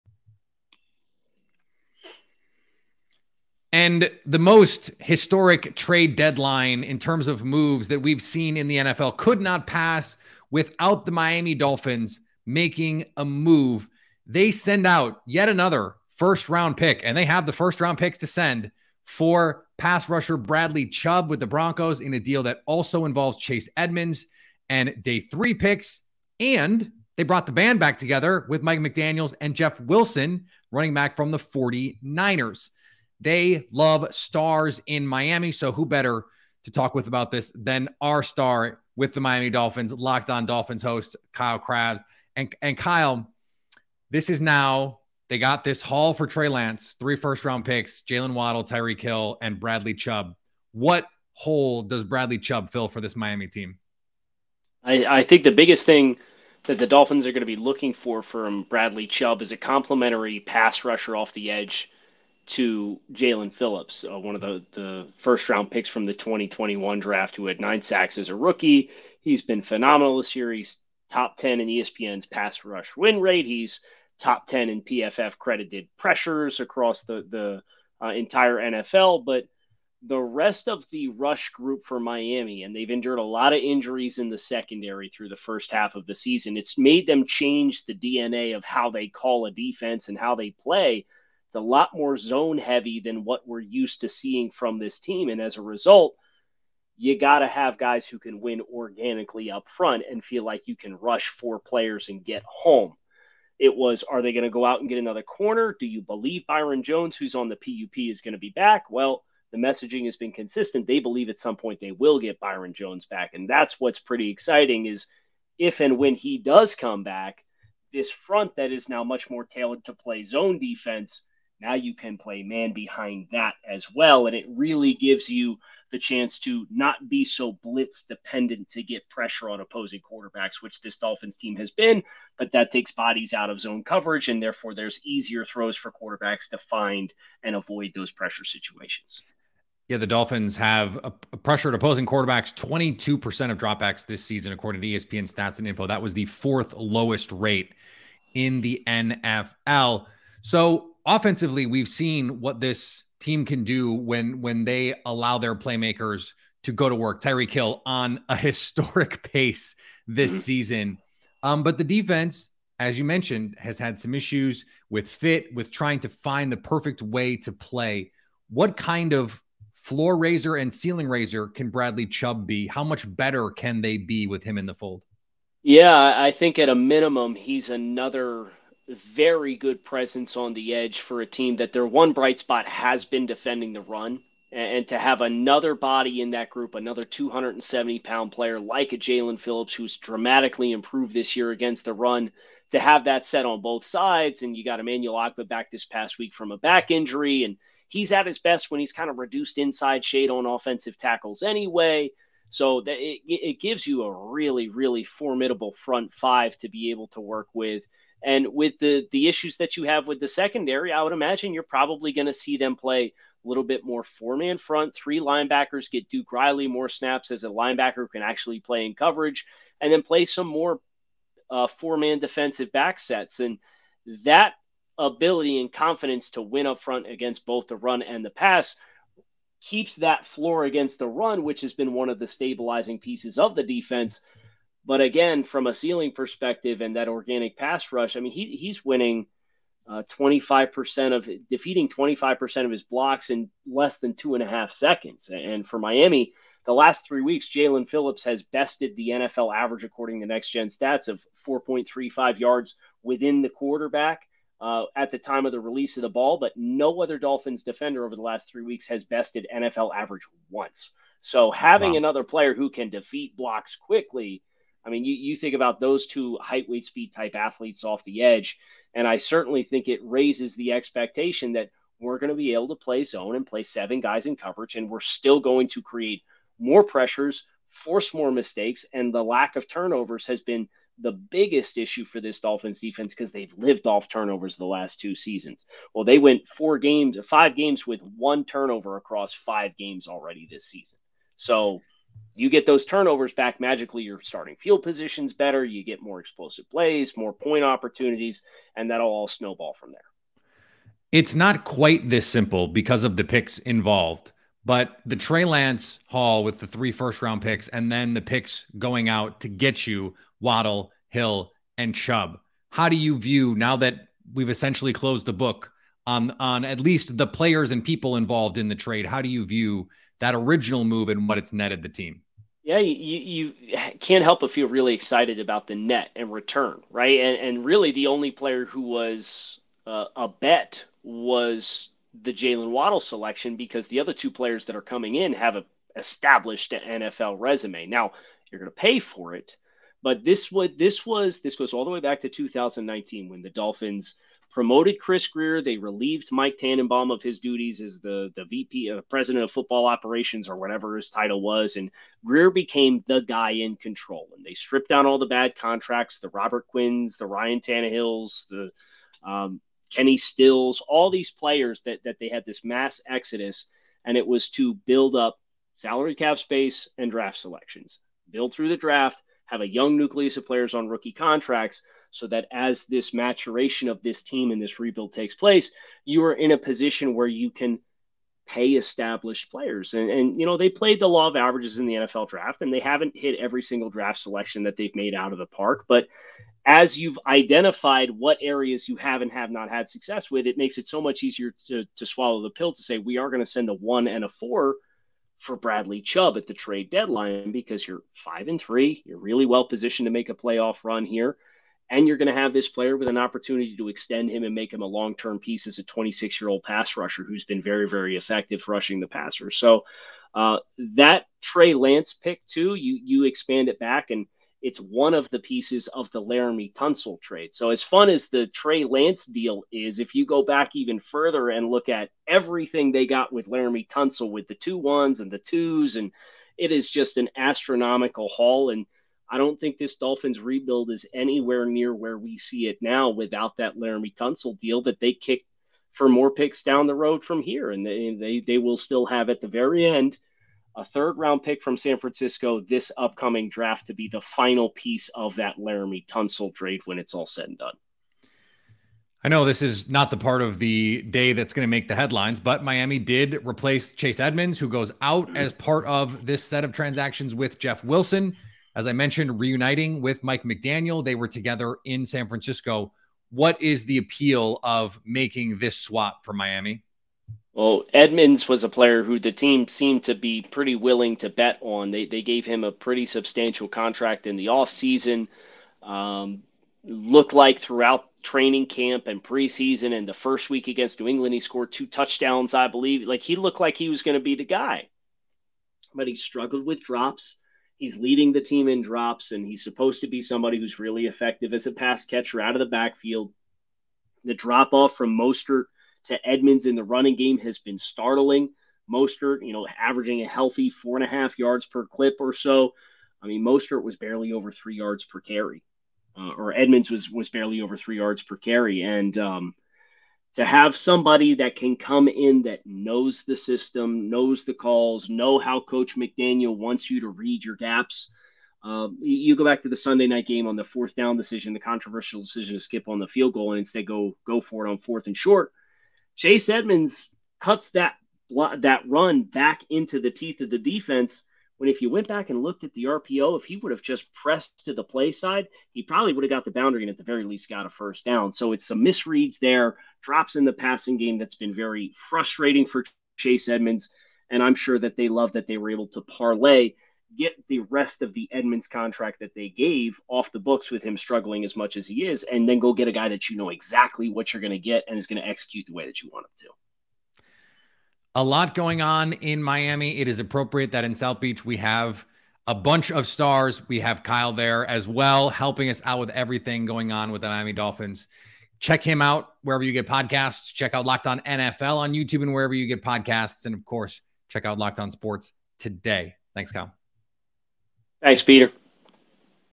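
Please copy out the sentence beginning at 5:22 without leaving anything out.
Yeah, you, you can't help but feel really excited about the net and return, right?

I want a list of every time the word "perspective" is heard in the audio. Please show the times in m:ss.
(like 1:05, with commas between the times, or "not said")
3:56.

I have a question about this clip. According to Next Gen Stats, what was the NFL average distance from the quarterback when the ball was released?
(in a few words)
4.35 yards.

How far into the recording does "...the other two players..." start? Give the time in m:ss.
5:33.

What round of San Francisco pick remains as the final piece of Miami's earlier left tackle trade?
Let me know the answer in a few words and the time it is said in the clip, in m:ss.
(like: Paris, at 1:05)
Third round, at 7:20.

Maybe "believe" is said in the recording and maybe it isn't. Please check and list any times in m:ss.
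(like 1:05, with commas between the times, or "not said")
1:46, 1:51, 8:02.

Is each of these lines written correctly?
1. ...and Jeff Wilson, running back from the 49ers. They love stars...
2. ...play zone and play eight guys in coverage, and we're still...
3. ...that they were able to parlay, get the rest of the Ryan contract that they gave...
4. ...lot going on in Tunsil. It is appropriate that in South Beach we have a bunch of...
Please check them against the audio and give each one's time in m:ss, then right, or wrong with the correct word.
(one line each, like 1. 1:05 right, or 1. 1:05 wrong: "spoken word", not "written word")
1. 0:29 right
2. 4:32 wrong: "seven", not "eight"
3. 9:05 wrong: "Edmonds", not "Ryan"
4. 9:18 wrong: "Miami", not "Tunsil".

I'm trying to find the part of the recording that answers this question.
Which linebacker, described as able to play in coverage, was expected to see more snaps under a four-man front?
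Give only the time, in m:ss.
3:36.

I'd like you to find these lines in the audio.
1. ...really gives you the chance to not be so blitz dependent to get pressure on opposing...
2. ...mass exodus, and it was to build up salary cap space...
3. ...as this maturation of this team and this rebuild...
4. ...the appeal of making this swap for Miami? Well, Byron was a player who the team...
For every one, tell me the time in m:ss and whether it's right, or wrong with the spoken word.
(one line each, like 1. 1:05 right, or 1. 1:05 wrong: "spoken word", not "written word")
1. 2:04 right
2. 6:02 right
3. 6:12 right
4. 7:43 wrong: "Edmonds", not "Byron".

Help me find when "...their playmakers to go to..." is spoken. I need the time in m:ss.
2:35.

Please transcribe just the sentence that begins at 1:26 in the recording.
It's made them change the DNA of how they call a defense and how they play.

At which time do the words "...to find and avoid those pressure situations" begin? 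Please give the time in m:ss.
2:16.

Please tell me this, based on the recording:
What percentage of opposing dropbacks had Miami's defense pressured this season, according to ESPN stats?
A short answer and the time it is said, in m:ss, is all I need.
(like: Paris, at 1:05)
22%, at 2:22.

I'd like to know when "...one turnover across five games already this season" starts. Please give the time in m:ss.
4:48.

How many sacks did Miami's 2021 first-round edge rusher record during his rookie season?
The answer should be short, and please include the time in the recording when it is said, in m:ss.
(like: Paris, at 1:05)
9, at 1:07.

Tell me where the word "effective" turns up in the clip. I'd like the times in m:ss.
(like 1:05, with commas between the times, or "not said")
6:48, 8:11.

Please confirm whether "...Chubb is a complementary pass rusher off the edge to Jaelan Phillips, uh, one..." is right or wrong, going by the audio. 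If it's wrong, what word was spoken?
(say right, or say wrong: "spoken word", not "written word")
right.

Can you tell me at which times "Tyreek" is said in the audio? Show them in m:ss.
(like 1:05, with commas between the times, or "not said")
0:48, 2:37.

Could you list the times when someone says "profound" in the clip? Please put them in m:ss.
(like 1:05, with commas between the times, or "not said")
not said.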